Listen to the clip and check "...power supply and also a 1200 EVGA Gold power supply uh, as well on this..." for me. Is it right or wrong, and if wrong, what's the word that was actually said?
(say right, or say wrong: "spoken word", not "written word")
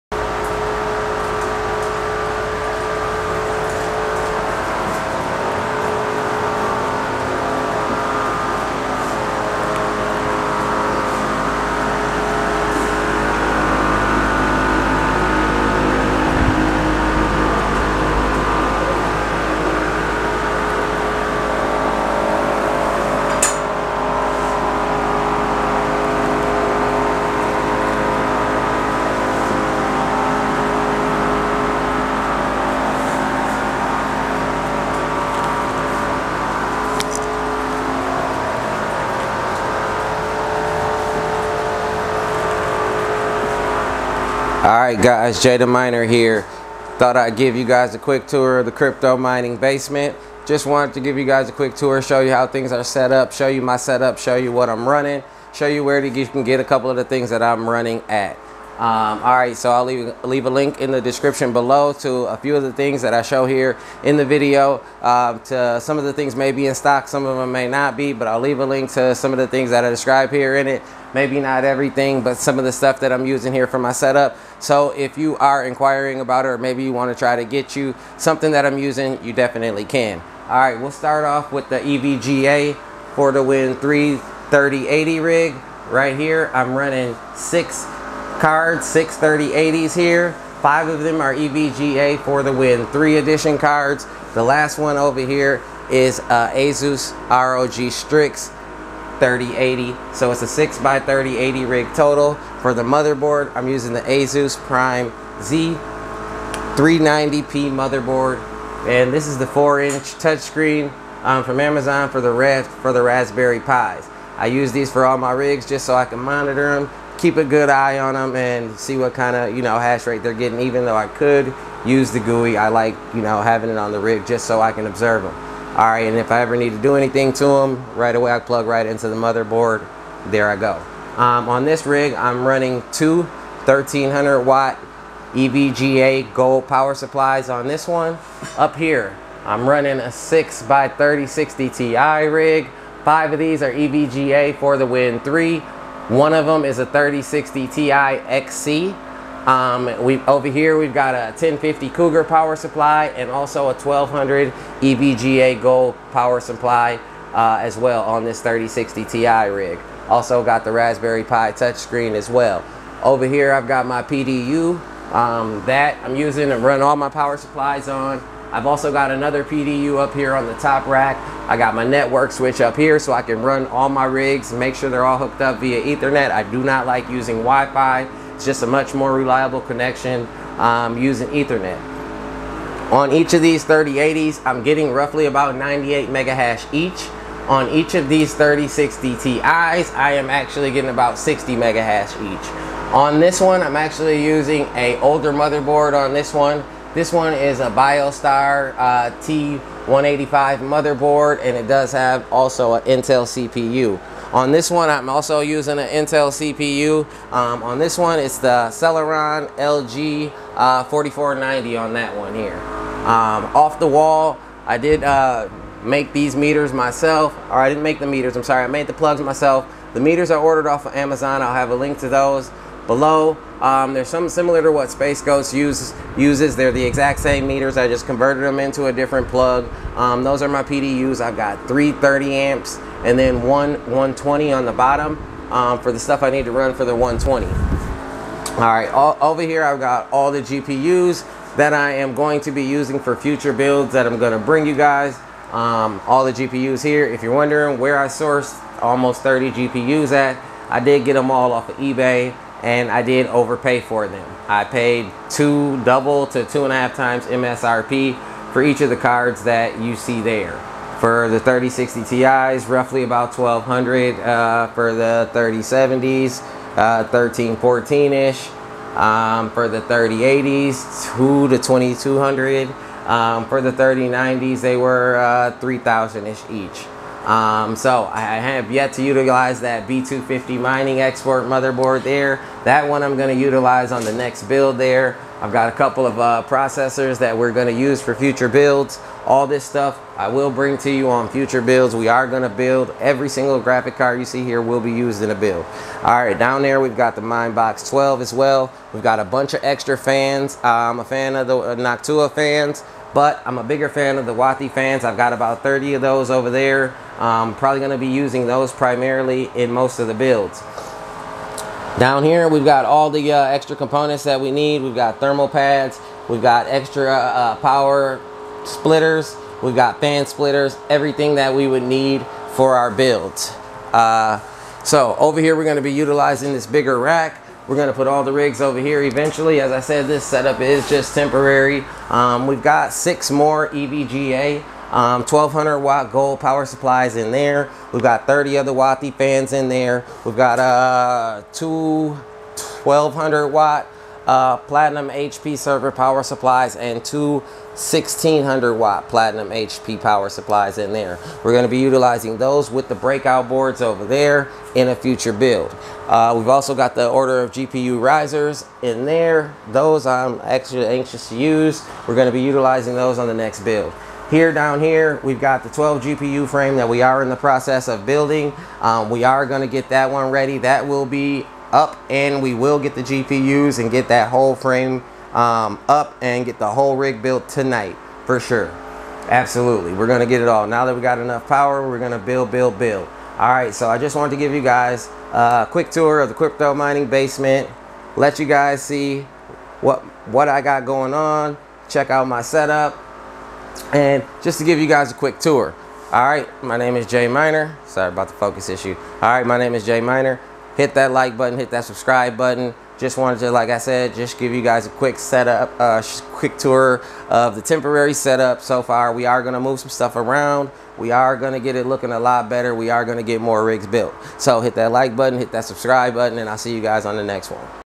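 right.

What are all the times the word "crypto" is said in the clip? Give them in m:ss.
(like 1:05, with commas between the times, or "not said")
0:48, 6:26.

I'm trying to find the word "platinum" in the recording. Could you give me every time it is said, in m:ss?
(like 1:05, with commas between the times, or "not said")
5:44, 5:49.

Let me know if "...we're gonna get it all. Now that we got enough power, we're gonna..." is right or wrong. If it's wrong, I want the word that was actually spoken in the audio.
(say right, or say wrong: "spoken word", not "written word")
right.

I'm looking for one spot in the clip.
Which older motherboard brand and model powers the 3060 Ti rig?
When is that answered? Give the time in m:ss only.
3:17.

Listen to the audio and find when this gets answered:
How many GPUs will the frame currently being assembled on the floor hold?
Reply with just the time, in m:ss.
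6:05.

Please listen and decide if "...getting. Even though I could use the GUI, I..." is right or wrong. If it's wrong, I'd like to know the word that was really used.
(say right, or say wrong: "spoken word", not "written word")
right.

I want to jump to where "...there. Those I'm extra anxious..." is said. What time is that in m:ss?
5:59.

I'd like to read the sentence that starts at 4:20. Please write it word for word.
For the 3060 Ti's, roughly about 1200 uh, for the 3070s, uh, 1314-ish.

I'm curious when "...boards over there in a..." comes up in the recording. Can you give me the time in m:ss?
5:53.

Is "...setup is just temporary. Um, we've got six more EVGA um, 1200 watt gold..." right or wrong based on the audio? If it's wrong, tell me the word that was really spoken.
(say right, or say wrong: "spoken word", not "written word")
right.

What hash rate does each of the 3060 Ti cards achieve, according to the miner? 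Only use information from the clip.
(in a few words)
60 megahash.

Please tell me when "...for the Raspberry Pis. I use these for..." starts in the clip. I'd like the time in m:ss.
1:52.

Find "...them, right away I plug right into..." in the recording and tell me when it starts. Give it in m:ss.
2:07.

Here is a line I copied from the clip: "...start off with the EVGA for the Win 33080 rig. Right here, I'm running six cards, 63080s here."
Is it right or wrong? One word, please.
right.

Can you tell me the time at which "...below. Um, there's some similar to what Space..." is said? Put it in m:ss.
3:42.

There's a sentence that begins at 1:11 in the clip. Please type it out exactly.
Maybe not everything, but some of the stuff that I'm using here for my setup.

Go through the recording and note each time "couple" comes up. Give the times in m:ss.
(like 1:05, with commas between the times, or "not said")
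0:56, 4:45.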